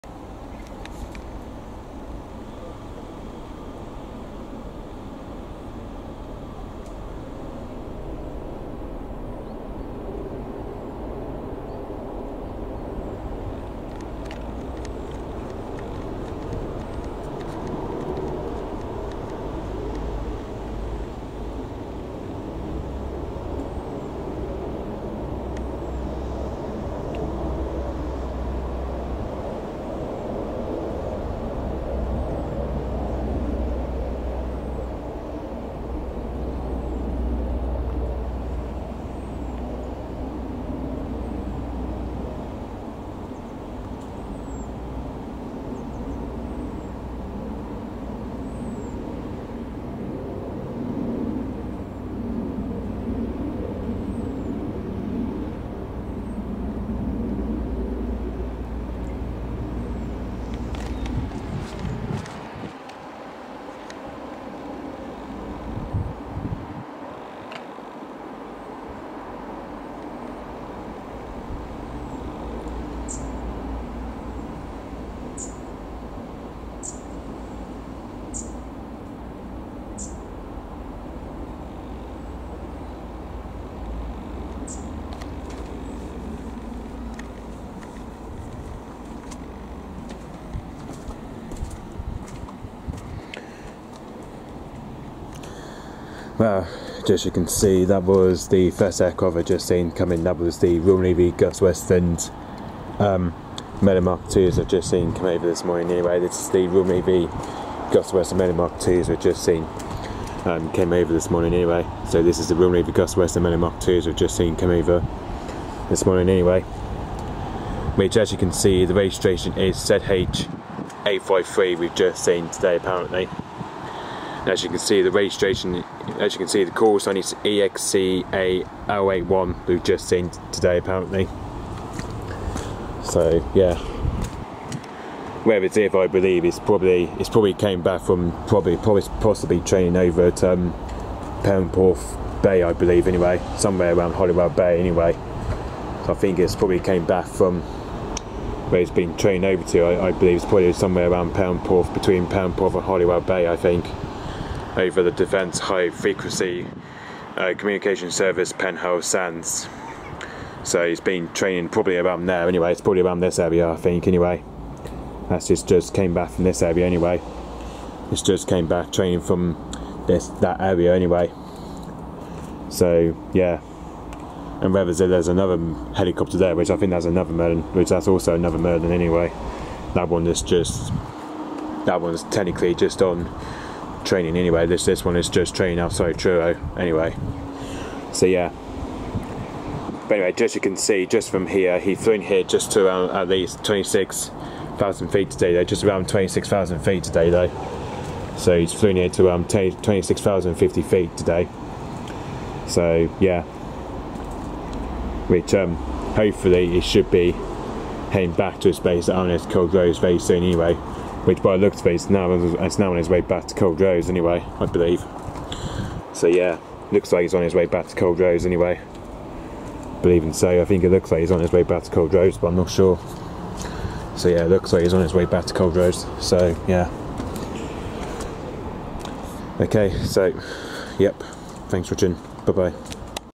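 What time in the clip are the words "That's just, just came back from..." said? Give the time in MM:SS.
02:45.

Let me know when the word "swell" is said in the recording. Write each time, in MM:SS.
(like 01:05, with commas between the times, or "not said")
not said.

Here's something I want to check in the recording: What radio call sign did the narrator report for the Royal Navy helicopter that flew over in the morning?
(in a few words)
EXCA081.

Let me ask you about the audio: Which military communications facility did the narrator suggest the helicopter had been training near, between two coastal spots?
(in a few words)
Penhale Sands.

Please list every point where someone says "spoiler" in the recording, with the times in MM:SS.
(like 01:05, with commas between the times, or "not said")
not said.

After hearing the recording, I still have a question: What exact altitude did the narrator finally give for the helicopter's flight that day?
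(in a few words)
26,050 feet.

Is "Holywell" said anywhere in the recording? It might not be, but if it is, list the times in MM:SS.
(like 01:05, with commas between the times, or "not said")
02:24, 02:32.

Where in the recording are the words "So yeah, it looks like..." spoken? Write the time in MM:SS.
03:44.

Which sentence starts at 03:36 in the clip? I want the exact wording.
So yeah, looks like he's on his way back to Culdrose anyway.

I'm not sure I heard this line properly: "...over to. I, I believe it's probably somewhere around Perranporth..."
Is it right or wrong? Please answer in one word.
right.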